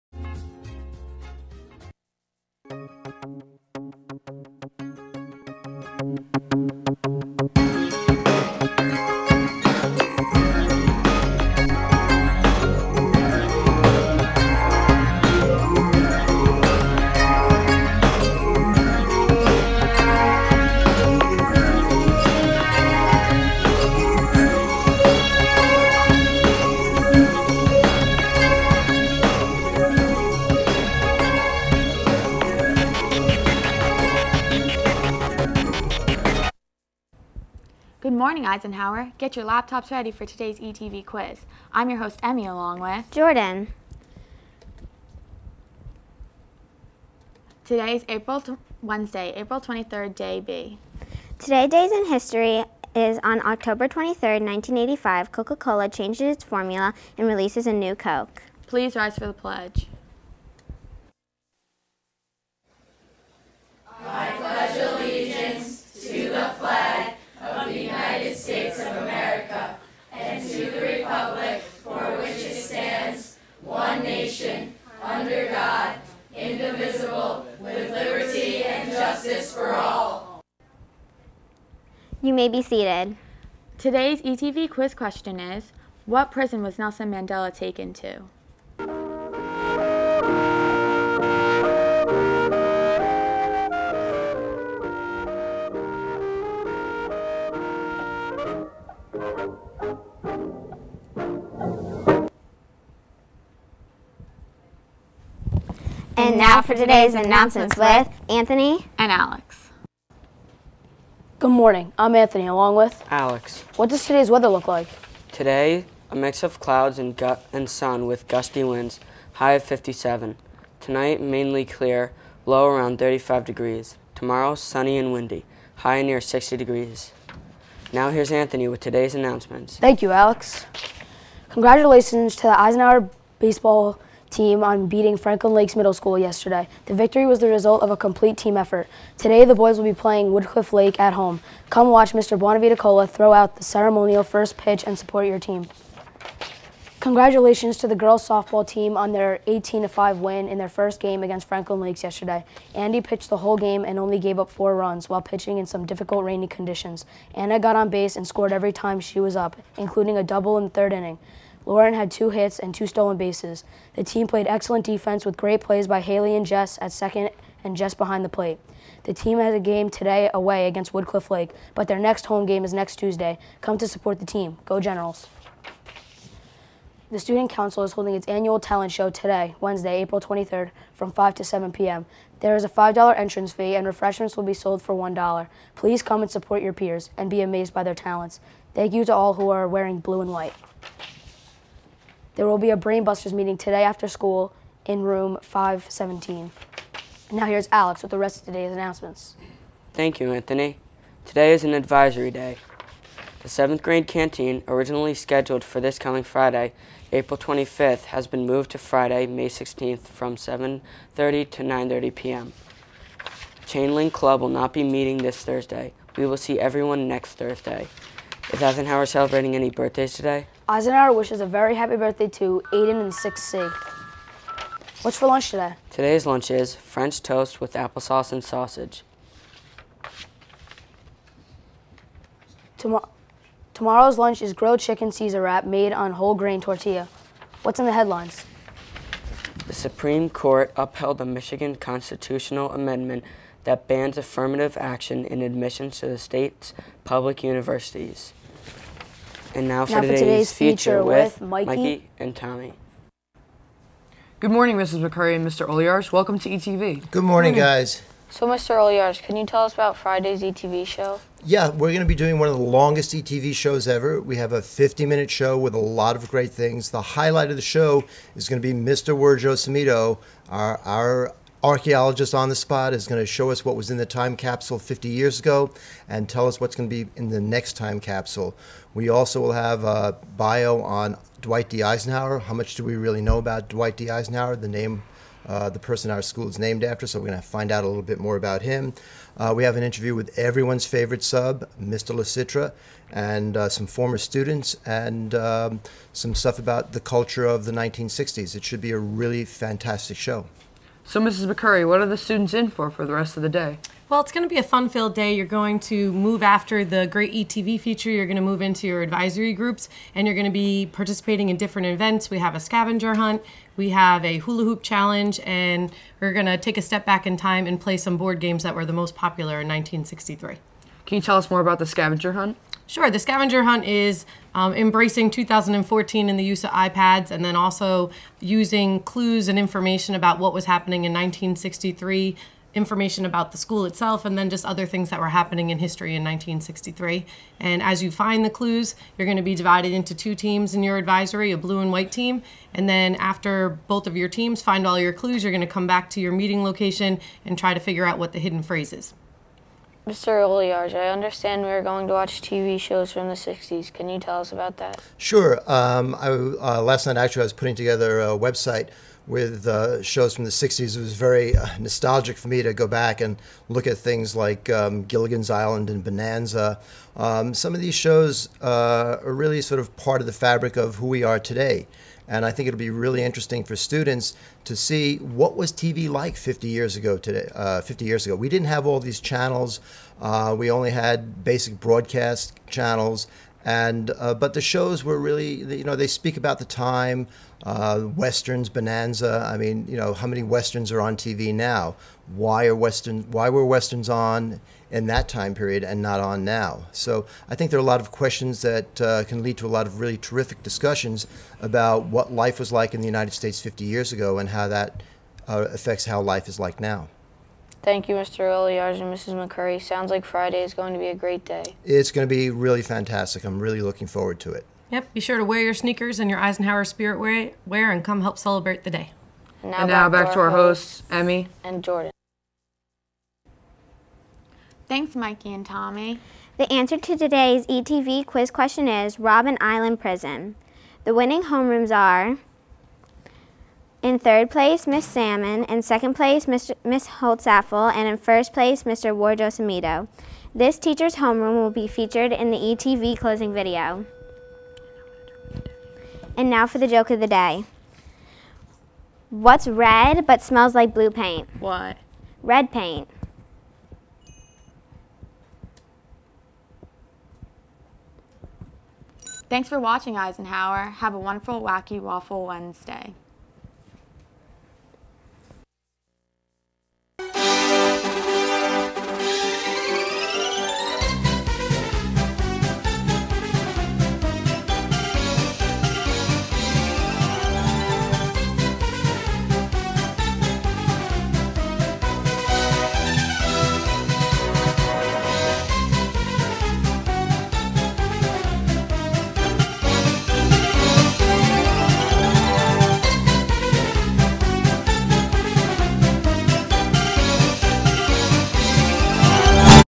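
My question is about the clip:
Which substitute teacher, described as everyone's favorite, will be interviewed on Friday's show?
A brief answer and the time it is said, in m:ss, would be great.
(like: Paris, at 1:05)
Mr. LaCitra, at 4:51.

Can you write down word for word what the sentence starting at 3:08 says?
Thank you to all who are wearing blue and white.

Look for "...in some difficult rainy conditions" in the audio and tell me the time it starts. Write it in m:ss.
2:35.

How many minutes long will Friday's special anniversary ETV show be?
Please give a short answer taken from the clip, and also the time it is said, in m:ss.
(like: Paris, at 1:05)
50 minutes, at 4:24.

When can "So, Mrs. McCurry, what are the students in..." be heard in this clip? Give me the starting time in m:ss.
5:01.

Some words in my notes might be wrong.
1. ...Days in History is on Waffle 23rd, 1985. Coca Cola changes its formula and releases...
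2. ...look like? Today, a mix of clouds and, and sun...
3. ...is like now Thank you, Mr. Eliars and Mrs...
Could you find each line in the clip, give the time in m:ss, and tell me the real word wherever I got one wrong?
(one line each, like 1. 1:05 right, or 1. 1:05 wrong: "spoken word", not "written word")
1. 0:51 wrong: "October", not "Waffle"
2. 1:54 right
3. 6:46 right.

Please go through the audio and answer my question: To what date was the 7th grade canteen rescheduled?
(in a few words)
Friday, May 16th.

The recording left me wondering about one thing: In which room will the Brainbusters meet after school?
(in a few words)
Room 517.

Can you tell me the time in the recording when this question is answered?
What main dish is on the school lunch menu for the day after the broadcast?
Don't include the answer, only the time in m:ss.
3:54.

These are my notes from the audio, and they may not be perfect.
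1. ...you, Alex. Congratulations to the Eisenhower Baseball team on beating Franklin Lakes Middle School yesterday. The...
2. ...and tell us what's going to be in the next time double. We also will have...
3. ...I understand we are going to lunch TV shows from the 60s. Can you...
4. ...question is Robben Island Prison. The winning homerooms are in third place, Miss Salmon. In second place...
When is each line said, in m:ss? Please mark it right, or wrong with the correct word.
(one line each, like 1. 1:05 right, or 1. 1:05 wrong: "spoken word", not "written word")
1. 2:10 right
2. 4:36 wrong: "capsule", not "double"
3. 5:50 wrong: "watch", not "lunch"
4. 7:08 right.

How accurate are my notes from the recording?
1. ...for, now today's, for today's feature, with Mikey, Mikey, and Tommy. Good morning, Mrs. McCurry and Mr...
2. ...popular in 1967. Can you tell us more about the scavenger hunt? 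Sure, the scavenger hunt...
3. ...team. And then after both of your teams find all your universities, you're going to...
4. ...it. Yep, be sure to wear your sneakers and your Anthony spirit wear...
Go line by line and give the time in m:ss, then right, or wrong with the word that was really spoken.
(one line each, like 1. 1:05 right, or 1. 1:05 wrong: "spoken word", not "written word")
1. 4:09 right
2. 5:19 wrong: "1963", not "1967"
3. 5:42 wrong: "clues", not "universities"
4. 6:54 wrong: "Eisenhower", not "Anthony".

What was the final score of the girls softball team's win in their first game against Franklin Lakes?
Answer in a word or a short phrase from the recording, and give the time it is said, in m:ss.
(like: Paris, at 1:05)
18-5, at 2:29.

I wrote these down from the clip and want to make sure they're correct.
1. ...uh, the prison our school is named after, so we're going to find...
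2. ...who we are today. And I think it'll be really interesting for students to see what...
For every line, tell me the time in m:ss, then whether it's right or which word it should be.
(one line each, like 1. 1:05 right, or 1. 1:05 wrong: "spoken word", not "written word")
1. 4:45 wrong: "person", not "prison"
2. 6:10 right.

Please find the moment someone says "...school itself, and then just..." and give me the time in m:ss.
5:33.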